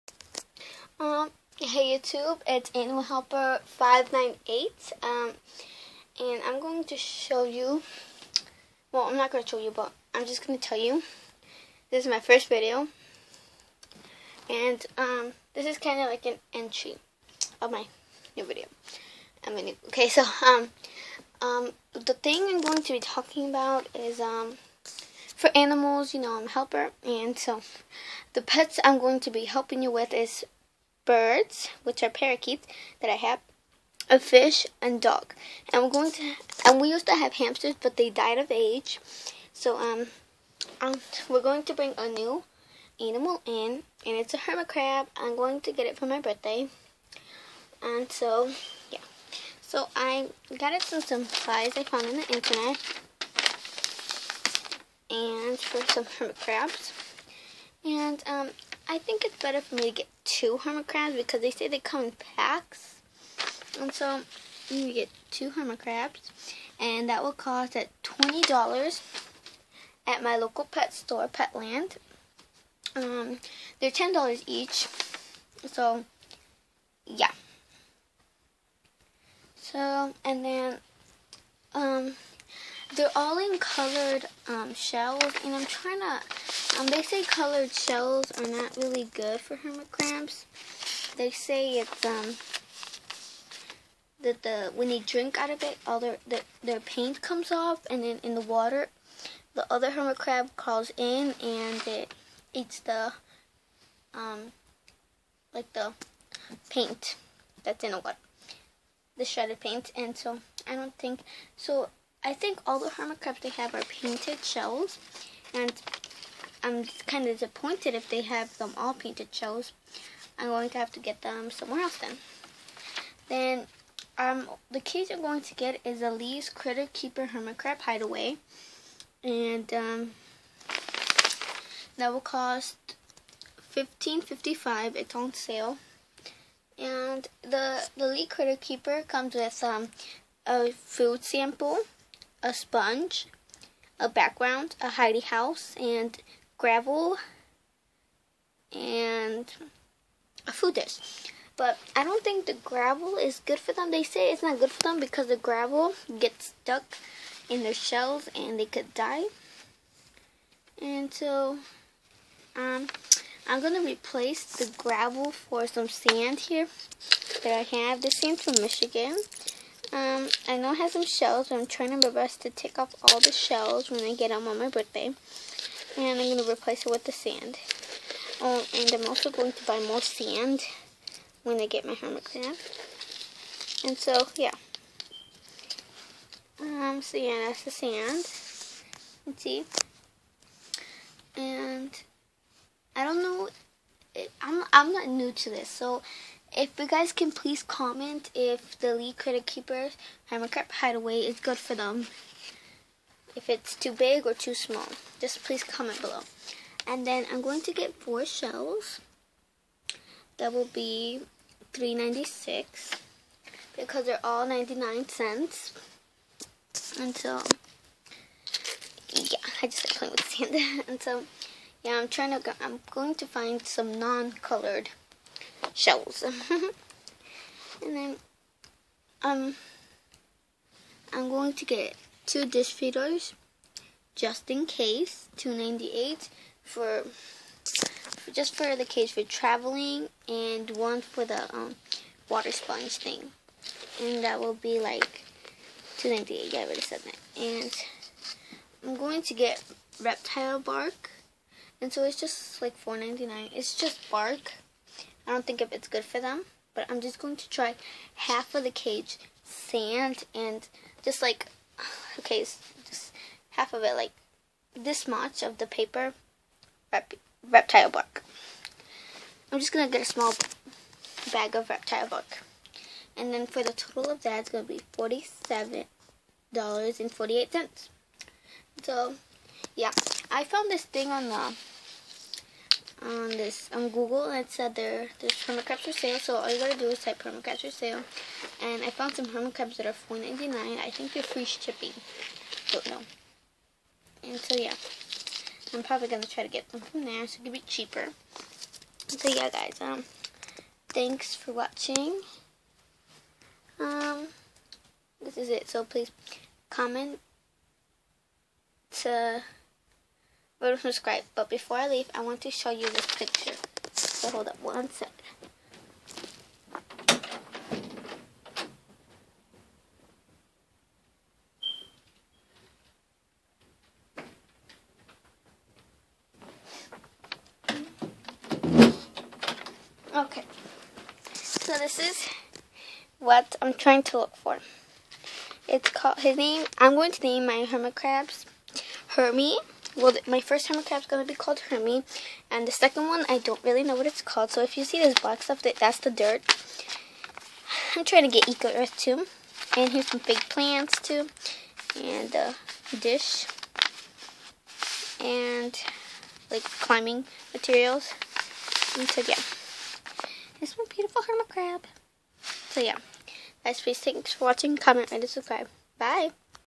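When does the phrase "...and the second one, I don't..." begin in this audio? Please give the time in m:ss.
5:42.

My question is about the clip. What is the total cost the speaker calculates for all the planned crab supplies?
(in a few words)
$47.48.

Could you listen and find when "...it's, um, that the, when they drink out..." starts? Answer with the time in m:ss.
1:31.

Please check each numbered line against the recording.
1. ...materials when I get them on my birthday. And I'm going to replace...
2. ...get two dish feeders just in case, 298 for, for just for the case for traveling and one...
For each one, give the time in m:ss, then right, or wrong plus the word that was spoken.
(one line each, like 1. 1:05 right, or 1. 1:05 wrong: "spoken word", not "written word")
1. 2:53 wrong: "shells", not "materials"
2. 3:51 right.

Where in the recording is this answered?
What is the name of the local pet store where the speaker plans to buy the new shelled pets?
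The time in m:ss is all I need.
1:11.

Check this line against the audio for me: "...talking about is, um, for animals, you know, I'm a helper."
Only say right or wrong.
right.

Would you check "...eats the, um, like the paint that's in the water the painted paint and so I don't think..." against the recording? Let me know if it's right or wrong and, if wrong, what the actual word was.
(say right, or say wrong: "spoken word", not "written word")
wrong: "shredded", not "painted".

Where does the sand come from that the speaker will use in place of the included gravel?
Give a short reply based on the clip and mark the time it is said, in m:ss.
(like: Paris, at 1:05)
Michigan, at 2:48.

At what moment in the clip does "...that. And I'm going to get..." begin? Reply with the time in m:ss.
4:07.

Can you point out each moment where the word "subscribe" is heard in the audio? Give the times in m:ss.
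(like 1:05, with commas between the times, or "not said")
5:10, 6:05.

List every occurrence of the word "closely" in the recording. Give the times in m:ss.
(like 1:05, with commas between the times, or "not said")
not said.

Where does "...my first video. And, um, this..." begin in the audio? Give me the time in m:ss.
0:12.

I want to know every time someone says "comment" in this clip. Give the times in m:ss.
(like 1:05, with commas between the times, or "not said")
3:17, 3:25, 5:06, 6:04.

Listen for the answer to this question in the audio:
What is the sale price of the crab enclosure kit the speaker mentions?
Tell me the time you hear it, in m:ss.
2:13.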